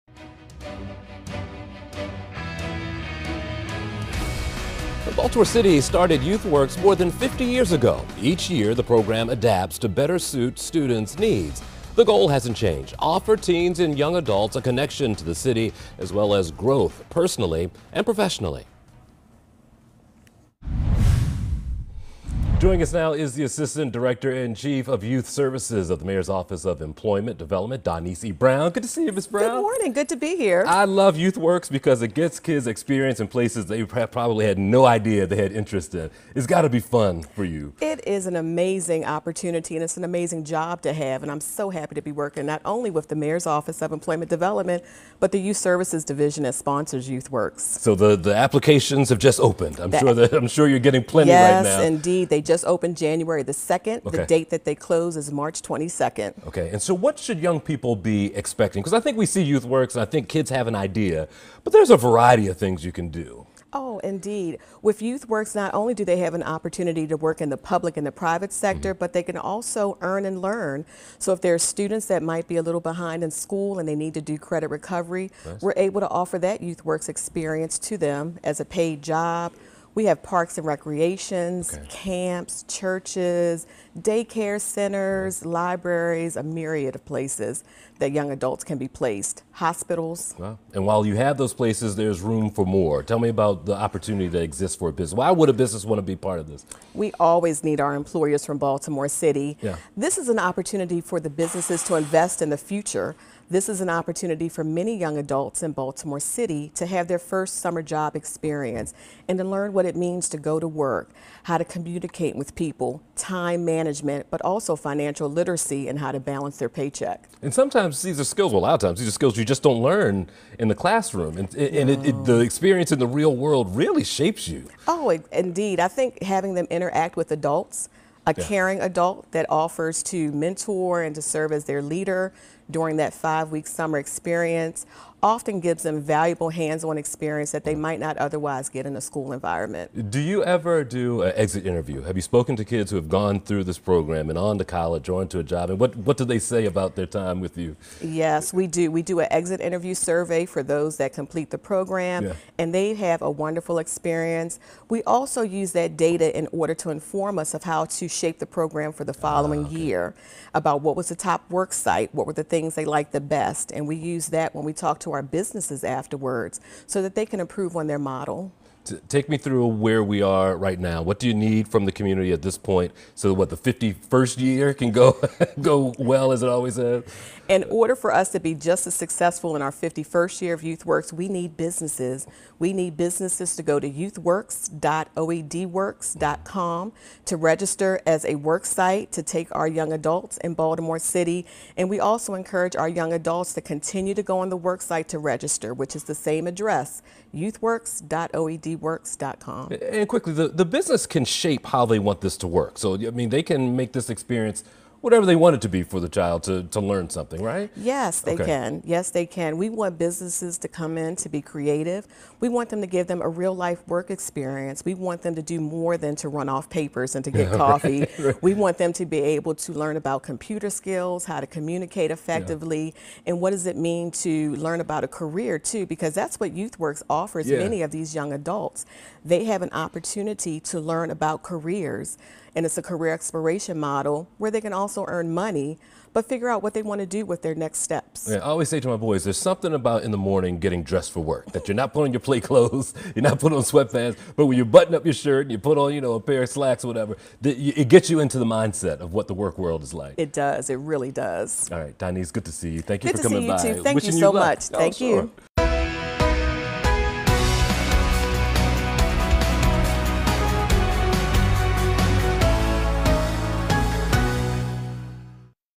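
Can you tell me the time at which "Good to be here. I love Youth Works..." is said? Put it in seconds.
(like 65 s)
29 s.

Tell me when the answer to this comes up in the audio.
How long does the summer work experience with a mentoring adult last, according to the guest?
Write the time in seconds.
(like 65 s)
133 s.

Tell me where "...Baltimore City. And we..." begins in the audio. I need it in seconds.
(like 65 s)
190 s.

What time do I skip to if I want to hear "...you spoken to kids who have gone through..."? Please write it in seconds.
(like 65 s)
142 s.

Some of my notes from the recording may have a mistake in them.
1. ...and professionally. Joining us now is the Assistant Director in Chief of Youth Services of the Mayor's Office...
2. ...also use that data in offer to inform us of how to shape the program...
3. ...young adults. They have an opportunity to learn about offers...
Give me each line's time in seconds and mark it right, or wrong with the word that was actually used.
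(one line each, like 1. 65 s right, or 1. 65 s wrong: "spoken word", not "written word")
1. 17 s right
2. 155 s wrong: "order", not "offer"
3. 228 s wrong: "careers", not "offers".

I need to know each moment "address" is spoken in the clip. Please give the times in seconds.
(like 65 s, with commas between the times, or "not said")
196 s.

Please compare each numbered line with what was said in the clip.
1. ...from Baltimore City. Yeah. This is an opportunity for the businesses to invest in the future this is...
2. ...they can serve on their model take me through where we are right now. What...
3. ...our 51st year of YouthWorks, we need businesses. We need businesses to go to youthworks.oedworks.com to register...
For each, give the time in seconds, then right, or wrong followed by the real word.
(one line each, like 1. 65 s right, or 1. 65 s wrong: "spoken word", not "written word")
1. 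98 s right
2. 167 s wrong: "improve", not "serve"
3. 179 s right.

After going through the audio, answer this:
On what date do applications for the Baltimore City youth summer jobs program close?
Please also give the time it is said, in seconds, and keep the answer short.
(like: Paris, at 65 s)
March 22, at 55 s.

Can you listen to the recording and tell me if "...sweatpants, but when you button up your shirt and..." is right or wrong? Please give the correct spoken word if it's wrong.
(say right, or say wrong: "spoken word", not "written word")
right.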